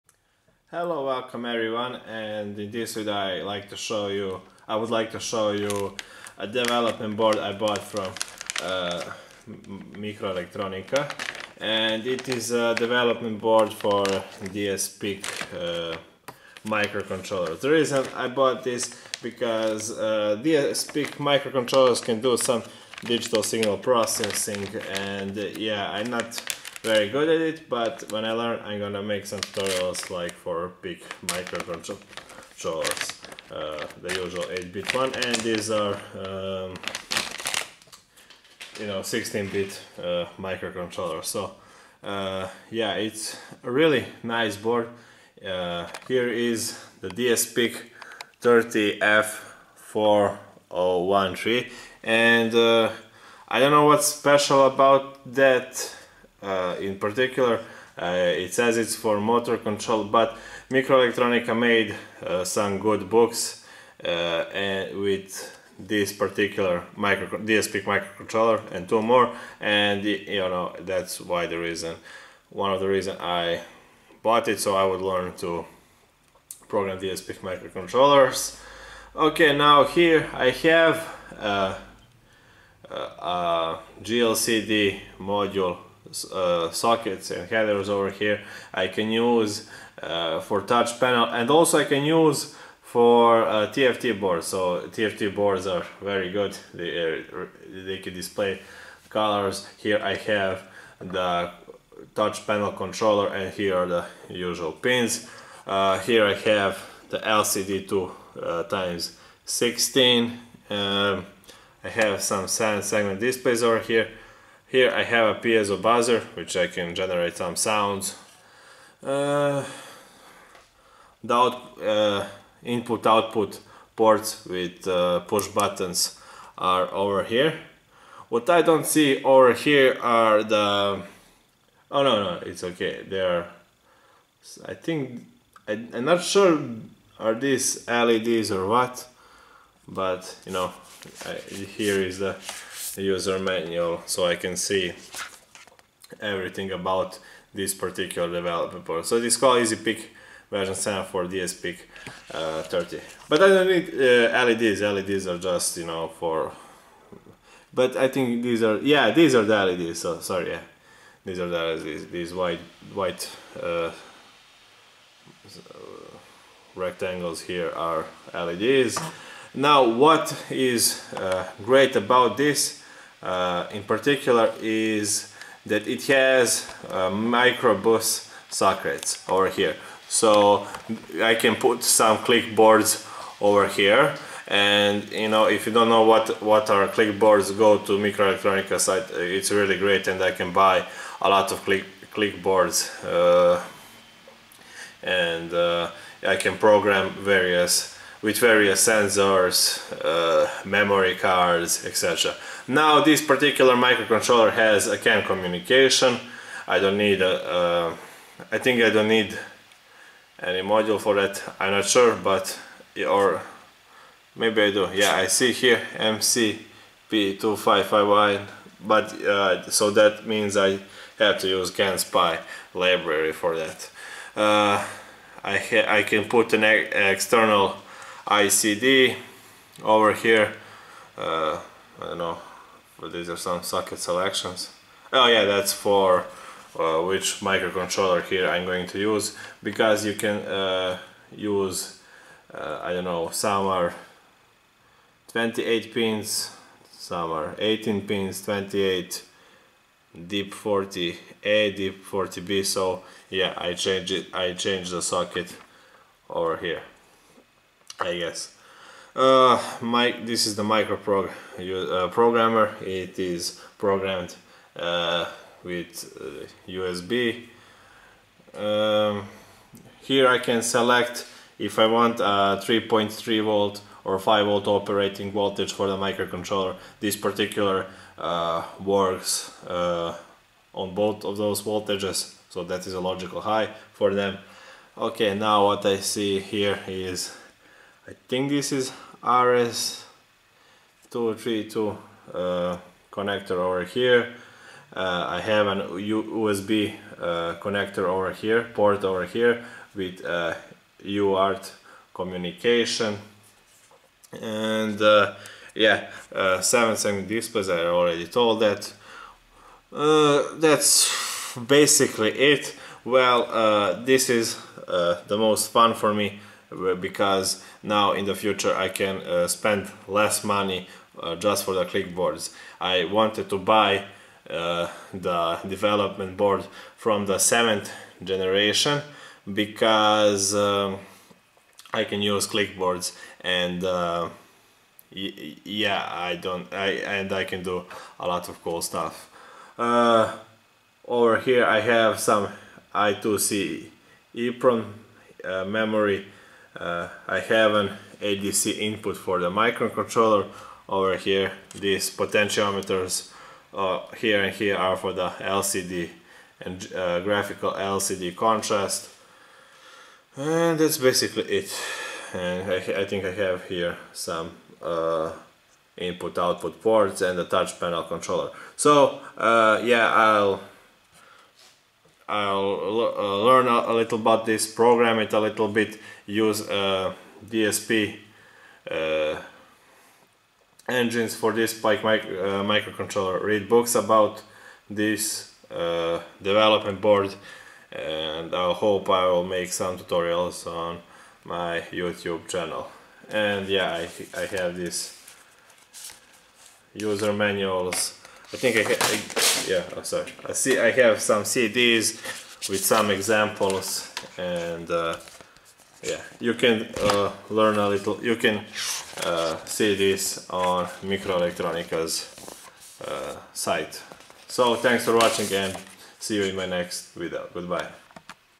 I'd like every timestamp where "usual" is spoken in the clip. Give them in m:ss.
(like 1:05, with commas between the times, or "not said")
0:34, 1:44.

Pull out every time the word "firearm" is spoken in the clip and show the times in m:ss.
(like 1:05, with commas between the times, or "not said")
not said.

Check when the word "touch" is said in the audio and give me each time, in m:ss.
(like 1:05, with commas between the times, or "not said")
1:30, 1:42, 6:07.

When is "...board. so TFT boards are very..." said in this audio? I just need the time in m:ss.
1:34.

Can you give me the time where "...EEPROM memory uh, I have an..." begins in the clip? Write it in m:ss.
5:44.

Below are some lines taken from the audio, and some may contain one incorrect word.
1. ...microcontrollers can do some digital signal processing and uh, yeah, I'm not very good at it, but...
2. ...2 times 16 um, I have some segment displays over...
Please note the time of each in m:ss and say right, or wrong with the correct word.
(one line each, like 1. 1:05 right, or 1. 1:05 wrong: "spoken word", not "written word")
1. 0:21 right
2. 1:47 right.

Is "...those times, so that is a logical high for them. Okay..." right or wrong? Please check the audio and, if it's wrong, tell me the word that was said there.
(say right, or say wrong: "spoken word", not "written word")
wrong: "voltages", not "times".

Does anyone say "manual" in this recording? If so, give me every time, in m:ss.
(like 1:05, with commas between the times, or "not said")
2:23, 6:37.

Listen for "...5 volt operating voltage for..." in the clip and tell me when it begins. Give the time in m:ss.
4:34.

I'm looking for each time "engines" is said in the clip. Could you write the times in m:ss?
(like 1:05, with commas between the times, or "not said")
6:20.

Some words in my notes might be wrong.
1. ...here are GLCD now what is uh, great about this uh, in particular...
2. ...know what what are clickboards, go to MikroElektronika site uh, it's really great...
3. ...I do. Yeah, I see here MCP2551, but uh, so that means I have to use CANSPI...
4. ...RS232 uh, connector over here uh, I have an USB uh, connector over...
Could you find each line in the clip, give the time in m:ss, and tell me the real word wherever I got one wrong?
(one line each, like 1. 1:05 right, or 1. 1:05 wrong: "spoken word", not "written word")
1. 2:47 wrong: "LEDs", not "GLCD"
2. 3:05 right
3. 3:34 right
4. 4:49 right.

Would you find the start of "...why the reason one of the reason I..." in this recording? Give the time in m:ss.
1:11.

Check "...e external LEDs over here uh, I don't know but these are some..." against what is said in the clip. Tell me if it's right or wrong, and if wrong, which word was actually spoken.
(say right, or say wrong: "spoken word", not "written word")
wrong: "ICD", not "LEDs".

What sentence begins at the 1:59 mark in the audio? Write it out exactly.
Uh, the out, uh, input output ports with uh, push buttons are over here.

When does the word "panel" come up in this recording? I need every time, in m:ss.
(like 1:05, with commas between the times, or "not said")
1:30, 1:42, 6:07.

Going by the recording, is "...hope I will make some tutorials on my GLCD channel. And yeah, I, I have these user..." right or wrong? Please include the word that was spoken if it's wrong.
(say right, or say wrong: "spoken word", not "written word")
wrong: "YouTube", not "GLCD".